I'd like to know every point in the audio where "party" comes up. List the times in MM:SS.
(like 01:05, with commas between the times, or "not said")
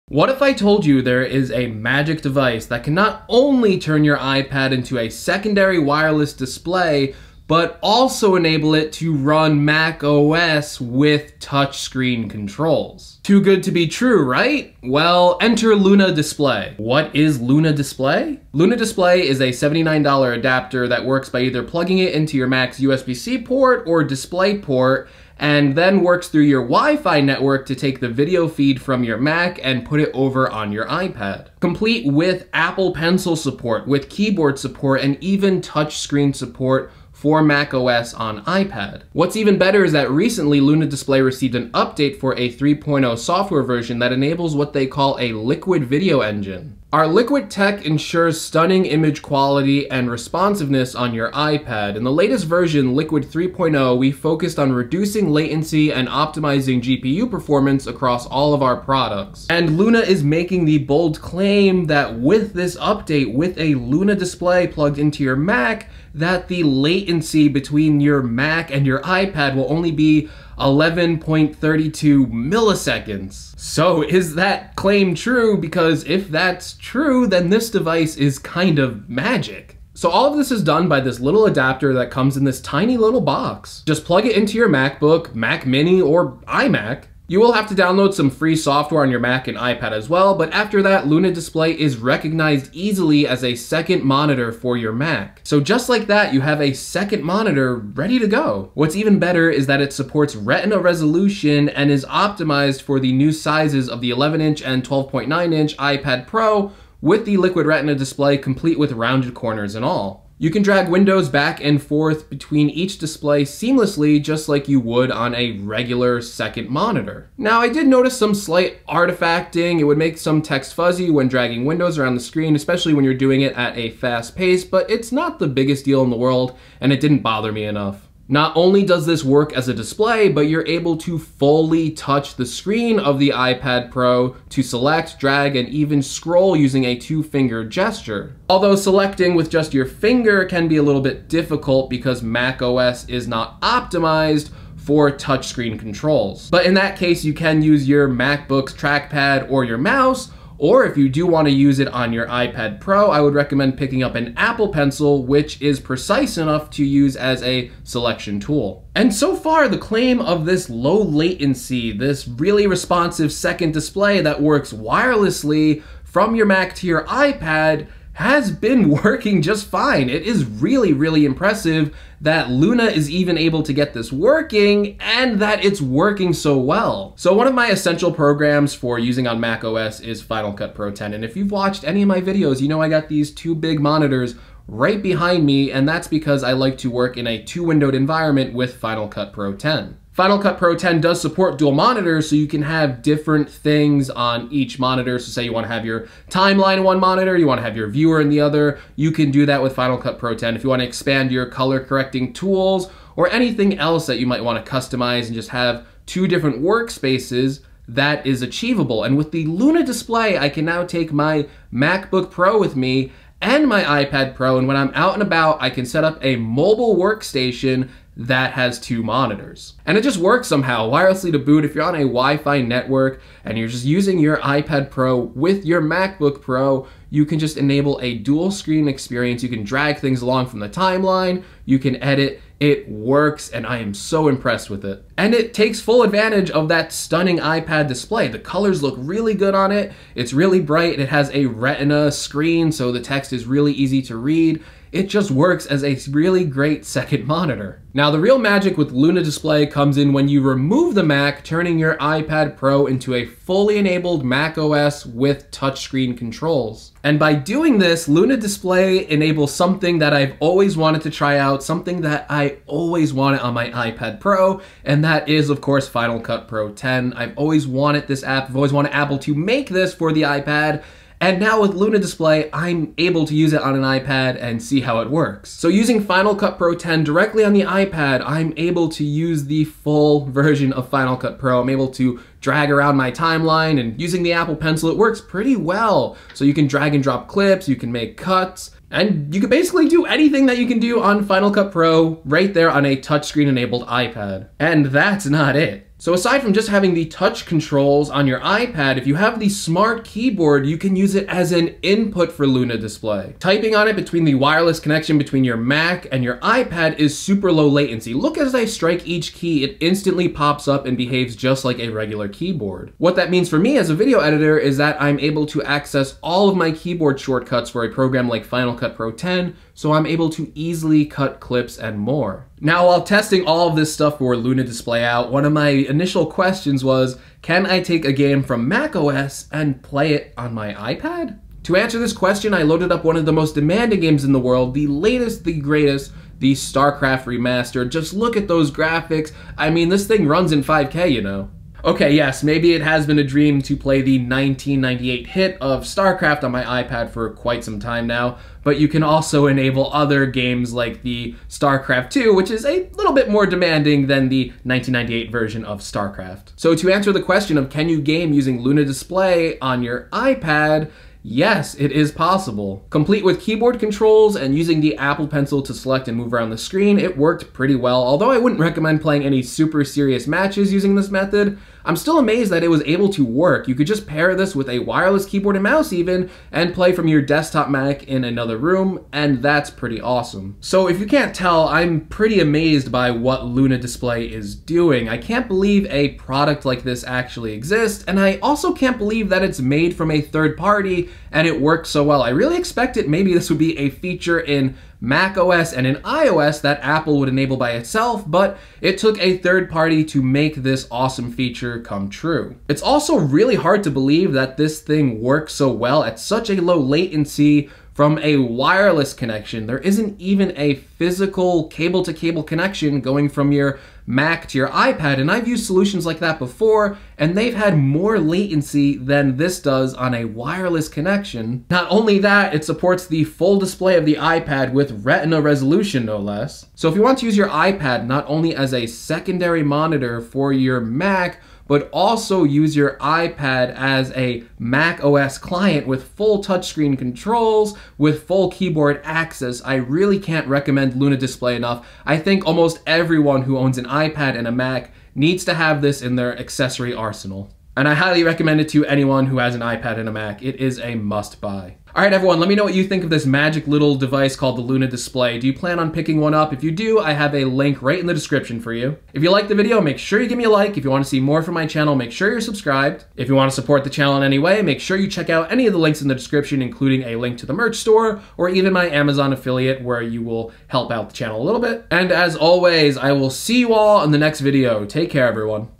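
06:30, 06:39.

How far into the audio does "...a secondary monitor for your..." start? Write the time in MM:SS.
07:08.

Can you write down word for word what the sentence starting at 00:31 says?
Complete with Apple Pencil support, with keyboard support, and even touchscreen support for Mac OS on iPad.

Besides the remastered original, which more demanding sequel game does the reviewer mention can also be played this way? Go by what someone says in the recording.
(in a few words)
StarCraft 2.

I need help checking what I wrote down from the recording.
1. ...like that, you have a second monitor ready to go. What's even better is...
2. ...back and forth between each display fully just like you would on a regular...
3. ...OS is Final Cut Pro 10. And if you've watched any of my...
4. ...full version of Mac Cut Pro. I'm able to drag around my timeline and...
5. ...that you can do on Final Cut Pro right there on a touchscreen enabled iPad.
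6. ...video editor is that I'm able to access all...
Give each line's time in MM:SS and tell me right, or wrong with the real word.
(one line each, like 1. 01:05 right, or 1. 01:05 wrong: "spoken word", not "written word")
1. 01:35 right
2. 01:51 wrong: "seamlessly", not "fully"
3. 02:59 right
4. 04:39 wrong: "Final", not "Mac"
5. 04:50 right
6. 05:13 right.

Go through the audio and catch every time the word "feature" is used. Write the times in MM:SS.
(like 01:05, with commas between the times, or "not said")
06:33, 06:41.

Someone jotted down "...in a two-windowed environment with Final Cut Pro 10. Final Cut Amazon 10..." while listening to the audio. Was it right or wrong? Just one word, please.
wrong.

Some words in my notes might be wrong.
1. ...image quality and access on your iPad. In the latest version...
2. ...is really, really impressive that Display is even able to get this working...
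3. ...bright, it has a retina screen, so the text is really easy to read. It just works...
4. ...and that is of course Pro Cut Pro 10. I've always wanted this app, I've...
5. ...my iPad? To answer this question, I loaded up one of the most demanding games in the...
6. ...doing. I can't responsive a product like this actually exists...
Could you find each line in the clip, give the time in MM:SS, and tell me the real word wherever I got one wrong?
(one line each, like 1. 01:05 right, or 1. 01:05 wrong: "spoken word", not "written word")
1. 00:48 wrong: "responsiveness", not "access"
2. 02:50 wrong: "Luna", not "Display"
3. 04:00 right
4. 04:24 wrong: "Final", not "Pro"
5. 05:30 right
6. 06:24 wrong: "believe", not "responsive".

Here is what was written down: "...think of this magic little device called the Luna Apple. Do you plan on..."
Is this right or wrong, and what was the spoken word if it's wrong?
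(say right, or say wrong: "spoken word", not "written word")
wrong: "Display", not "Apple".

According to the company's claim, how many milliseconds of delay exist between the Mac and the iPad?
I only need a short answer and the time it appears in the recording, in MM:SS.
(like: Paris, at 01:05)
11.32, at 01:10.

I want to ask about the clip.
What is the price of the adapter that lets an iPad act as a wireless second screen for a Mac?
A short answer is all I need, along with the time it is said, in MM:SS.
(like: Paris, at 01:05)
$79, at 00:19.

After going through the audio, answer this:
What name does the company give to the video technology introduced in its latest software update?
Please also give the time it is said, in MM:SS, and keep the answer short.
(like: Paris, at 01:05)
Liquid video engine, at 00:45.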